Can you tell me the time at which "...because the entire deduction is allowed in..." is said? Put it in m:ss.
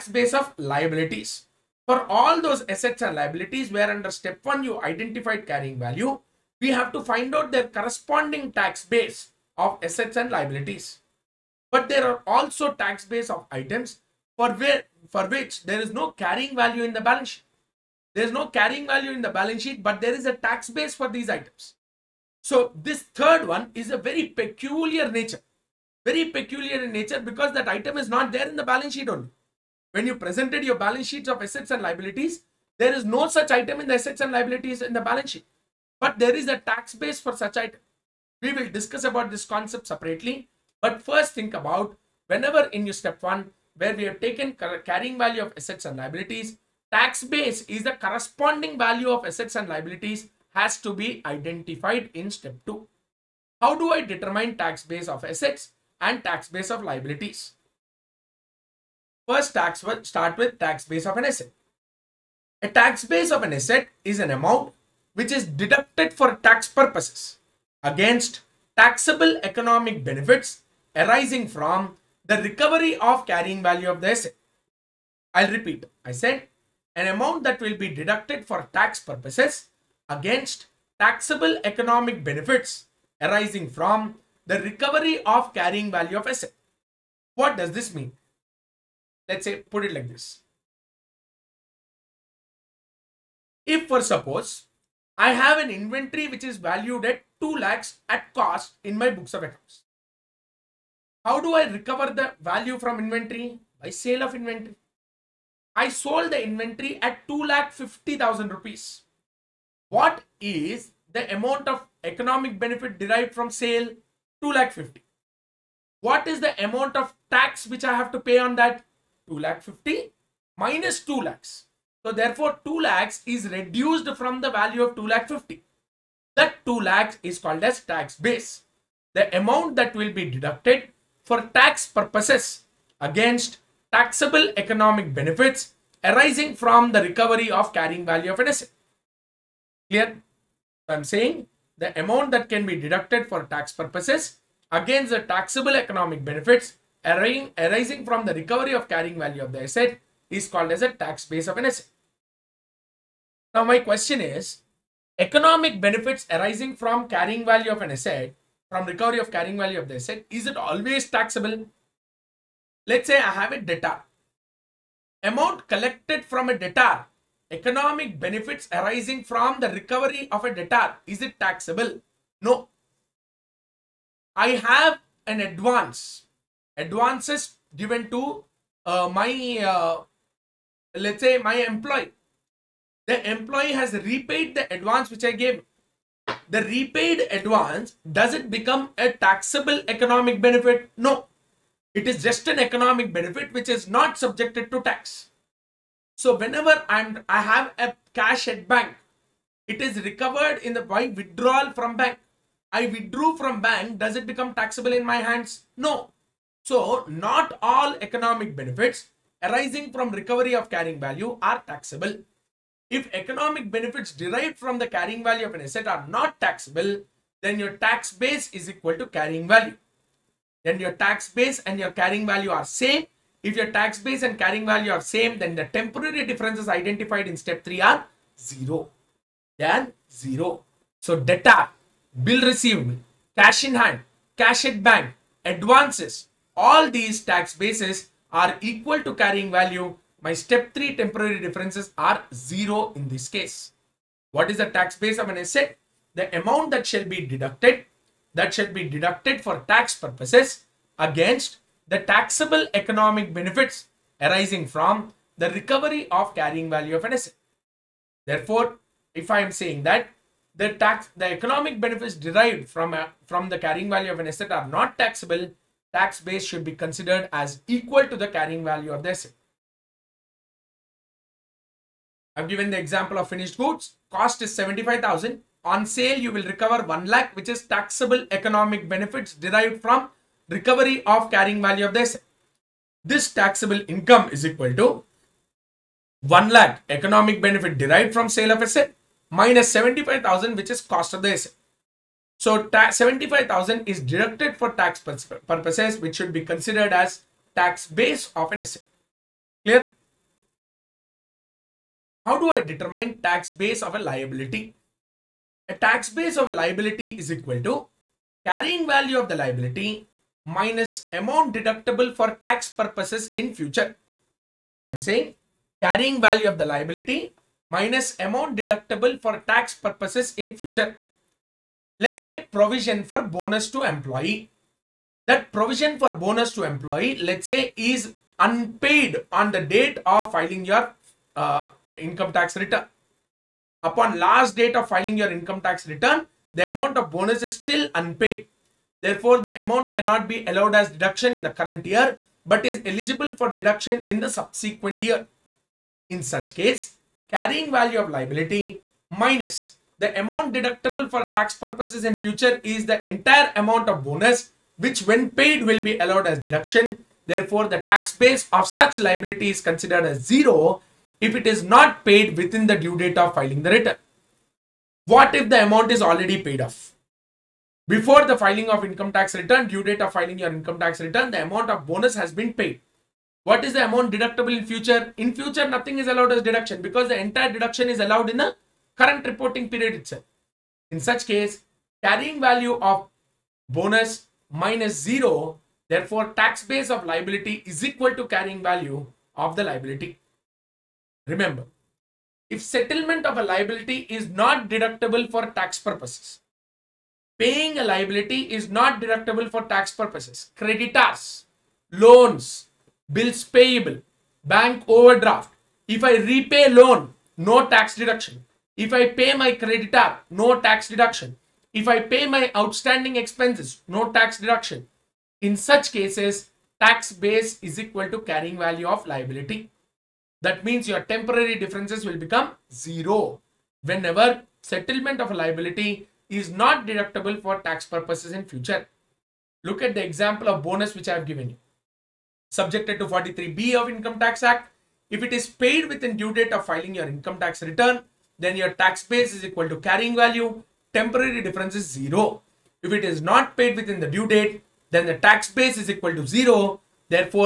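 6:16.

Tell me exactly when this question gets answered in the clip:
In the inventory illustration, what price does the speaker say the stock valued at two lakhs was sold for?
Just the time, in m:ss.
1:47.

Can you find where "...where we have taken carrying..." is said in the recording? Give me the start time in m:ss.
0:43.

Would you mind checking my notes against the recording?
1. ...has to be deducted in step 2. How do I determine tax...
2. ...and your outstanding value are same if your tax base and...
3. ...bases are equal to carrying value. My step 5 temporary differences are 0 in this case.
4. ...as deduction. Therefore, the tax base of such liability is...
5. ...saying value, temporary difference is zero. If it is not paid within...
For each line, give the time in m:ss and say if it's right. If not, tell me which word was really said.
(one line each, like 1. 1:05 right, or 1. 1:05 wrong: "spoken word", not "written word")
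1. 0:50 wrong: "identified", not "deducted"
2. 3:41 wrong: "carrying", not "outstanding"
3. 3:57 wrong: "3", not "5"
4. 5:56 right
5. 7:19 wrong: "carrying", not "saying".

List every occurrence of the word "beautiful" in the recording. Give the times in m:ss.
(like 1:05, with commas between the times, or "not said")
not said.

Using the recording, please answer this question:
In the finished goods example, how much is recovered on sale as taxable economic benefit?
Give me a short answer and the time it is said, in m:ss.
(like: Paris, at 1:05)
1 lakh, at 4:36.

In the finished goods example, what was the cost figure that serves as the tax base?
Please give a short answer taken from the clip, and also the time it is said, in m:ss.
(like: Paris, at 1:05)
75,000, at 4:34.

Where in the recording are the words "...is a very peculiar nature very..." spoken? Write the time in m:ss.
0:23.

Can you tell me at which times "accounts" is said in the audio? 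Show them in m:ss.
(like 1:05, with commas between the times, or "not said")
1:39.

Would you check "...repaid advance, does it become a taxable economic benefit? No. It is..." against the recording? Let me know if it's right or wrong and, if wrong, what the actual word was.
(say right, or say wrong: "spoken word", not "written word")
right.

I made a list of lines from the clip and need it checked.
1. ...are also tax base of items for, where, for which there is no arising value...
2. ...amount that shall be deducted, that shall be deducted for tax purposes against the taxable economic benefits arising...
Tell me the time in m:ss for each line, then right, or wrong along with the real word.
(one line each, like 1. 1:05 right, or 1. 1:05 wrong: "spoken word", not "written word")
1. 0:12 wrong: "carrying", not "arising"
2. 4:06 right.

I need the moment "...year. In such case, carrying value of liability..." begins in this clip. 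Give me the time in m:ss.
5:44.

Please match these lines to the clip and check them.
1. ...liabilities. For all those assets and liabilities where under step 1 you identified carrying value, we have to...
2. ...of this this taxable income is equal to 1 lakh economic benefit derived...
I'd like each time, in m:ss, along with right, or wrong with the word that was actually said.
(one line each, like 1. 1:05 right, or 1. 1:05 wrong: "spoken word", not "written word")
1. 0:00 right
2. 4:41 right.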